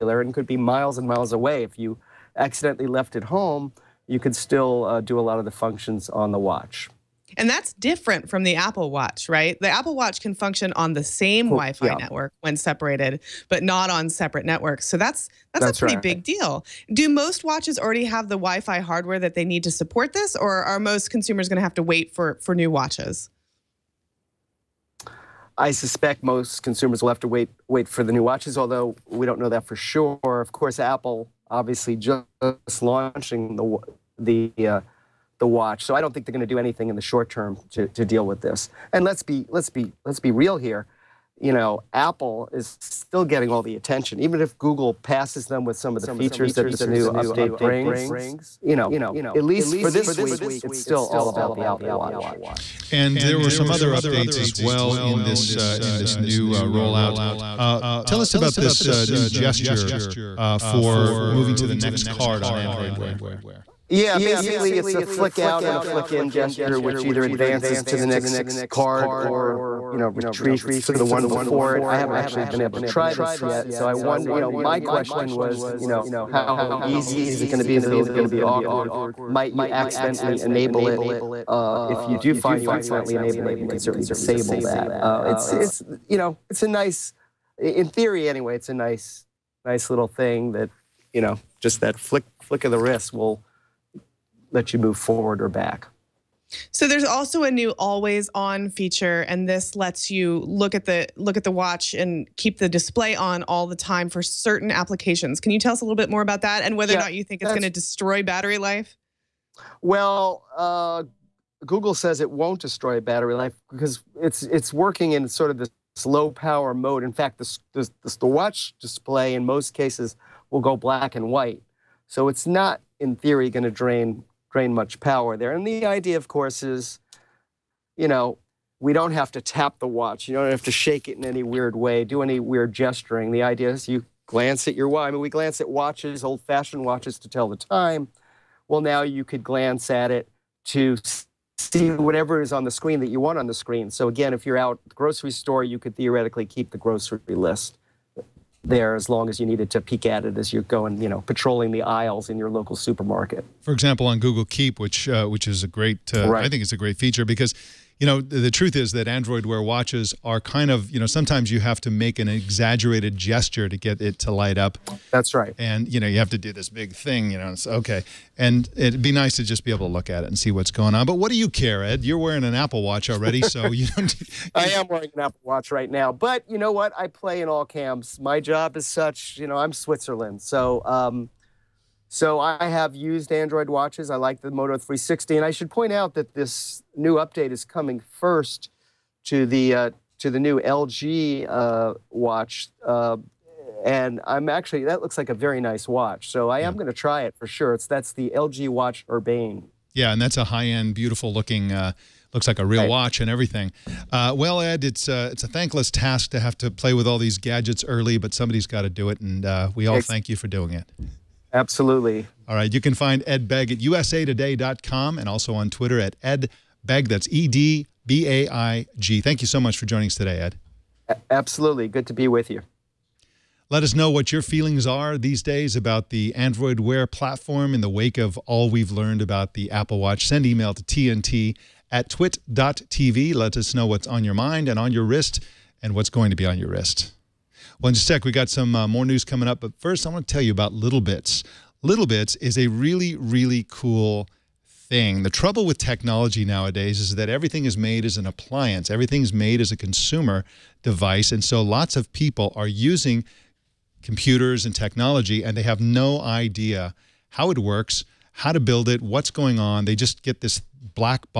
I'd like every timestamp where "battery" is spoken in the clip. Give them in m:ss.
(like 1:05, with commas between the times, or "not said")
1:48, 1:53.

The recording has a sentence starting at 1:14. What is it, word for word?
You know, my question was, you know, how easy is it going to be?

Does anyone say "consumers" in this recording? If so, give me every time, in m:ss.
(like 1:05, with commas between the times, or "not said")
0:21, 0:26, 4:09.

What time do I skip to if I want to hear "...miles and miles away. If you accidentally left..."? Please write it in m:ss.
0:00.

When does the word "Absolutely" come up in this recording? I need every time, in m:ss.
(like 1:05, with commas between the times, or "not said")
3:31, 3:41.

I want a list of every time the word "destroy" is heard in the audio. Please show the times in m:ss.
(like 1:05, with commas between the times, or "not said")
1:47, 1:52.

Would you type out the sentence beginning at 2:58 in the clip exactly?
My job is such, you know, I'm Switzerland.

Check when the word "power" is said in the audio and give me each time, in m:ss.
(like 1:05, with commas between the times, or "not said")
1:56, 2:04.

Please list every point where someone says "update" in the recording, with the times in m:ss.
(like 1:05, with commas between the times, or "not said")
0:47, 0:53, 3:07.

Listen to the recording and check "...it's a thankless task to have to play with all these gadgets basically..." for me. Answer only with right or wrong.
wrong.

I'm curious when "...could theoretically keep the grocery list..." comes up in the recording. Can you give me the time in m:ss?
2:25.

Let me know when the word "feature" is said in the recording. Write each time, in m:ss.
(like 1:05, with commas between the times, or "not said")
0:46, 1:38, 2:36.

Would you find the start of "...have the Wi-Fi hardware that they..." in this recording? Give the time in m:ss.
0:18.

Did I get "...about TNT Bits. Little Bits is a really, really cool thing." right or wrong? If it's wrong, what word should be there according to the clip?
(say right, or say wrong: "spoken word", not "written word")
wrong: "Little", not "TNT".